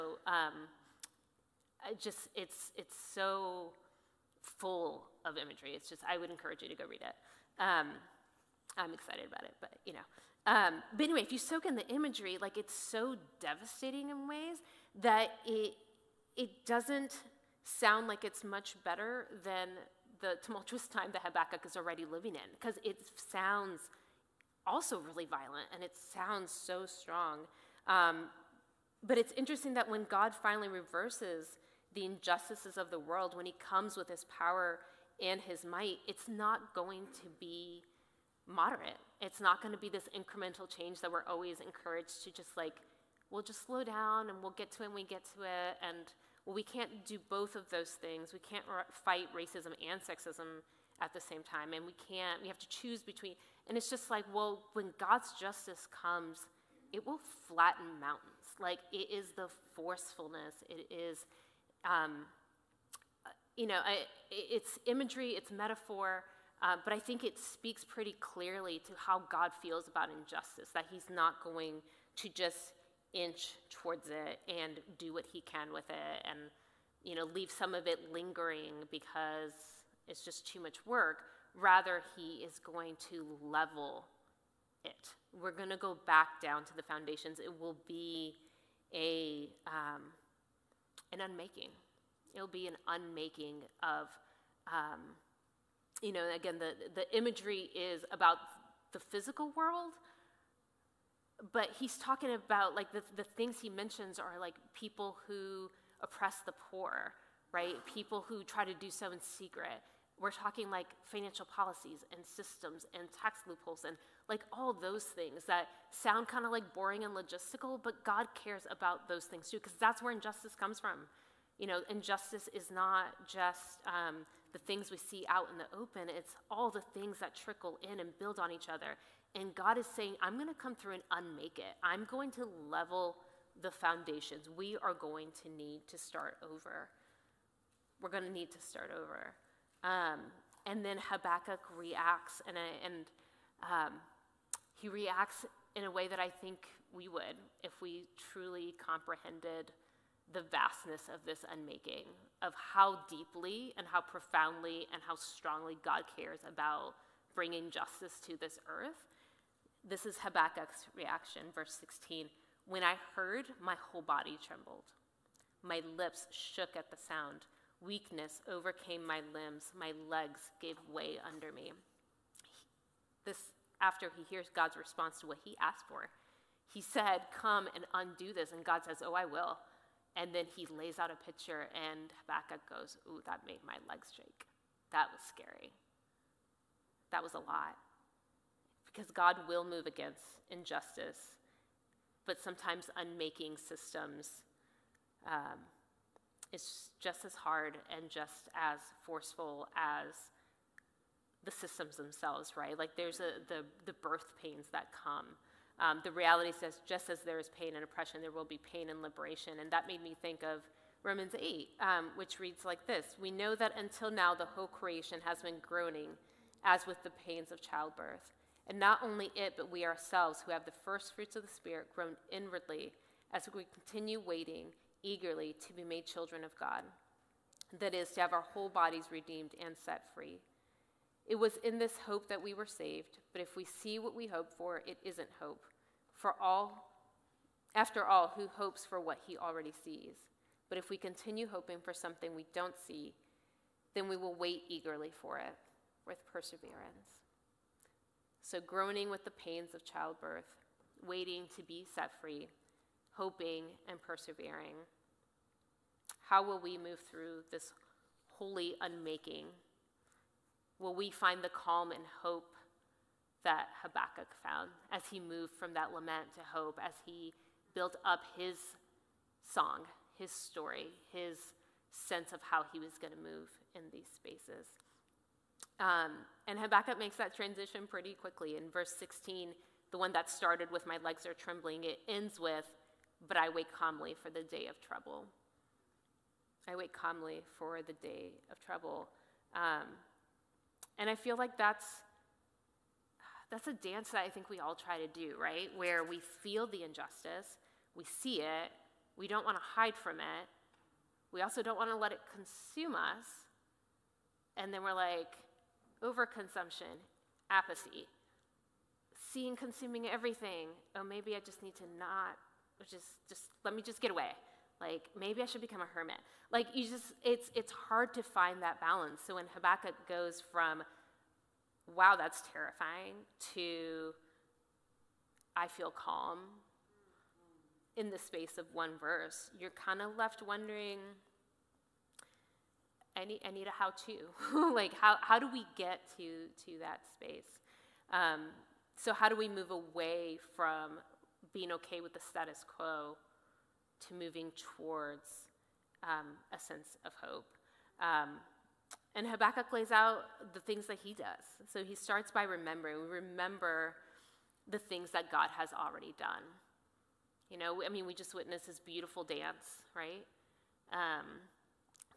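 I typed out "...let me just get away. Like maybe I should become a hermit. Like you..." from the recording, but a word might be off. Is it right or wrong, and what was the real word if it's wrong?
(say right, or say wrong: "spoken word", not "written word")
right.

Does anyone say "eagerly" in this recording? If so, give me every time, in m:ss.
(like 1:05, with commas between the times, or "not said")
3:45, 4:04.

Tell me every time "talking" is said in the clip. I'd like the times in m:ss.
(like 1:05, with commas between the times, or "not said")
1:41, 1:50.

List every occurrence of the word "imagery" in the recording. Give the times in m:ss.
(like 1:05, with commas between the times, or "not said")
0:05, 0:11, 1:04, 1:37.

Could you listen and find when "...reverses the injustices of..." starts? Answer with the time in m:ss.
0:30.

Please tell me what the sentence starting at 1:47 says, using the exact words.
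People who try to do so in secret.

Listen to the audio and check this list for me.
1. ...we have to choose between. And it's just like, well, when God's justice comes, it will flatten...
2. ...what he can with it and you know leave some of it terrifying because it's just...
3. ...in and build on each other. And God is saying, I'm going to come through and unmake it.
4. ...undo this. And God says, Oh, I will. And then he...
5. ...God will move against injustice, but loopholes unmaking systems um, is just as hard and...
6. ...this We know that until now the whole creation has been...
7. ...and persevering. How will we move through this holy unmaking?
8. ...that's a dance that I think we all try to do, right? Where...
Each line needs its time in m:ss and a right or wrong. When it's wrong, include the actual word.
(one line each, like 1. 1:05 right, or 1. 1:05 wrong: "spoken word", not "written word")
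1. 0:52 right
2. 1:15 wrong: "lingering", not "terrifying"
3. 2:07 right
4. 2:57 right
5. 3:09 wrong: "sometimes", not "loopholes"
6. 3:32 right
7. 4:13 right
8. 4:53 right.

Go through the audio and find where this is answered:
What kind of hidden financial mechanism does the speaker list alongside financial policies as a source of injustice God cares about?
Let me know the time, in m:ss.
1:53.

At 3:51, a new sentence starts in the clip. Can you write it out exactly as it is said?
It was in this hope that we were saved, but if we see what we hope for, it isn't hope.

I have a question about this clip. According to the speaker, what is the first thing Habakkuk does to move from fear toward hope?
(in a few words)
remembering.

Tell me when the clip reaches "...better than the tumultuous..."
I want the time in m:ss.
0:18.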